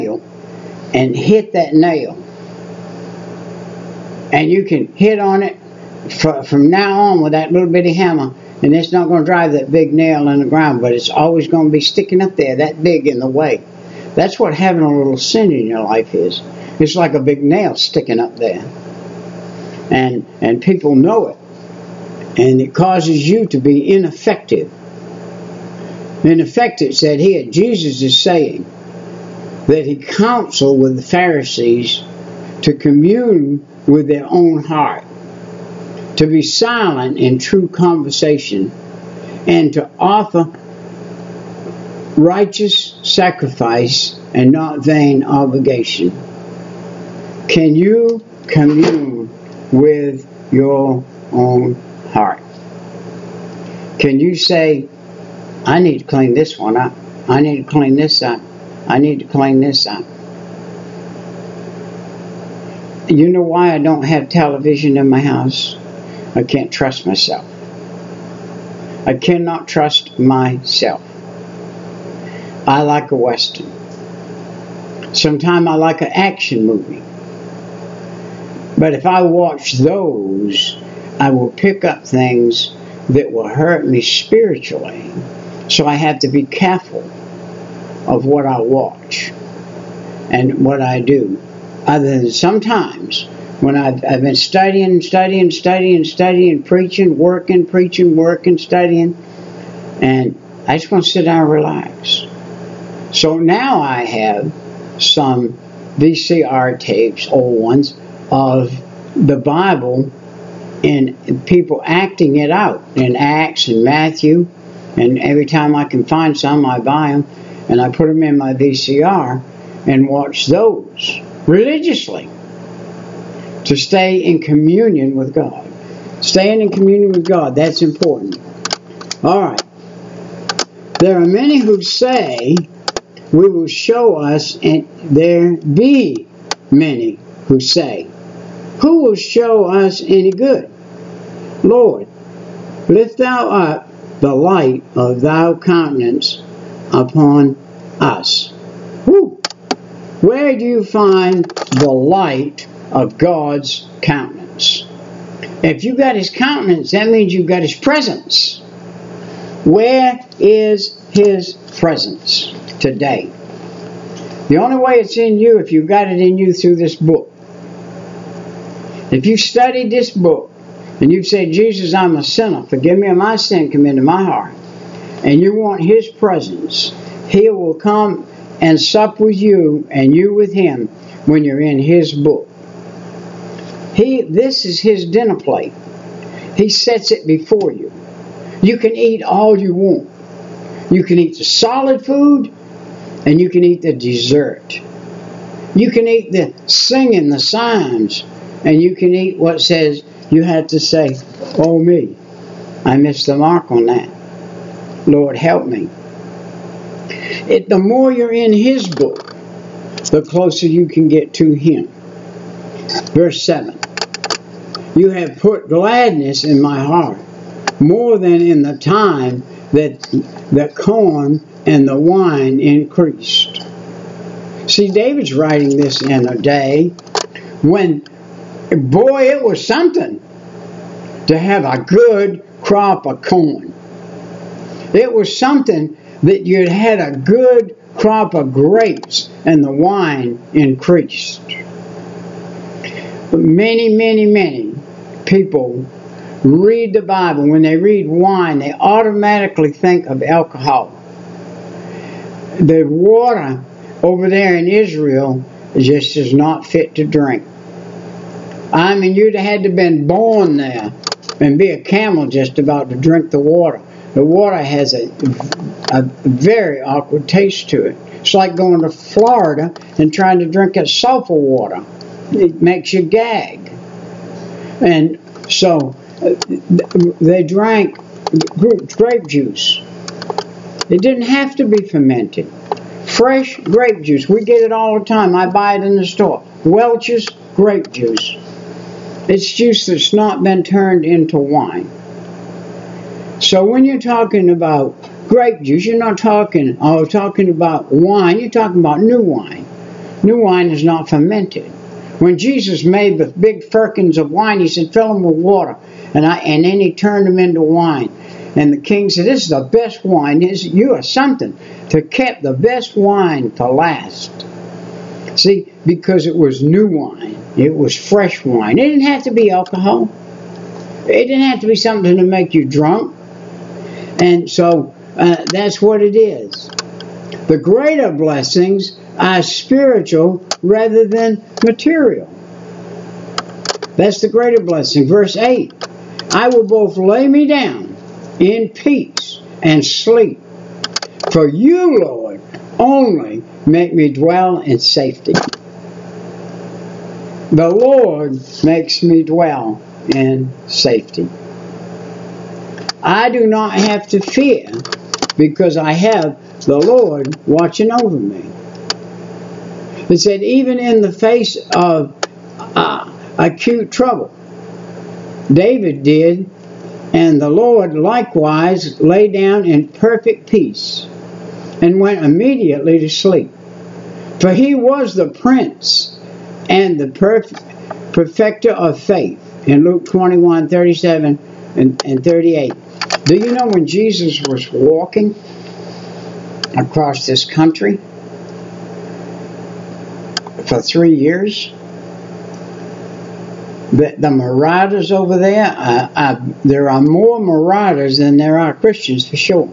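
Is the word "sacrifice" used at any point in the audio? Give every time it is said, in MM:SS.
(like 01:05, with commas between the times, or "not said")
00:43.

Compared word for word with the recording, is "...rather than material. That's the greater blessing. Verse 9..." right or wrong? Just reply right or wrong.
wrong.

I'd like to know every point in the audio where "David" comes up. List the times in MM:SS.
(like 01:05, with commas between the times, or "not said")
03:44, 06:05.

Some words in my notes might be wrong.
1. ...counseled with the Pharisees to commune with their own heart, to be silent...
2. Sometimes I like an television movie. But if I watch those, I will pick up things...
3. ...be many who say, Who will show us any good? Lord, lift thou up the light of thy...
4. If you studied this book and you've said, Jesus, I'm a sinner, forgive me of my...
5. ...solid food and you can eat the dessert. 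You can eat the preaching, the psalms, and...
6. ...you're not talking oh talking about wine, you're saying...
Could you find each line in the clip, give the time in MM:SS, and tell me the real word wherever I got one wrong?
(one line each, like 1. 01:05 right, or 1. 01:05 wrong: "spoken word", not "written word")
1. 00:29 right
2. 01:15 wrong: "action", not "television"
3. 02:15 right
4. 02:49 right
5. 03:11 wrong: "singing", not "preaching"
6. 04:55 wrong: "talking", not "saying".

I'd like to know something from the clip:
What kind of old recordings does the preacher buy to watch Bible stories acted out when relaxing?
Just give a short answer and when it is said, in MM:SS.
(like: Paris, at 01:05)
VCR tapes, at 01:45.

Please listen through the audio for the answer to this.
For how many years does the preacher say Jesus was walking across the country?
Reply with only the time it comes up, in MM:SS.
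06:30.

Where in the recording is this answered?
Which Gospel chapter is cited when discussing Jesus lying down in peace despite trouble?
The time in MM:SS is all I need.
06:19.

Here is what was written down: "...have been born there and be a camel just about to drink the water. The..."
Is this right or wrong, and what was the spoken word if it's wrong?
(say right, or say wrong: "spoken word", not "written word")
right.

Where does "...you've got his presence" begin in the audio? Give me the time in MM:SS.
02:37.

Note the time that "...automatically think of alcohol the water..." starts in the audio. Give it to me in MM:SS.
04:08.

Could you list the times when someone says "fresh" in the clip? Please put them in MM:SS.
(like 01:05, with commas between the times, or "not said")
04:43, 05:17.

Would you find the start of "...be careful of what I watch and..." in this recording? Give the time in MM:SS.
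01:26.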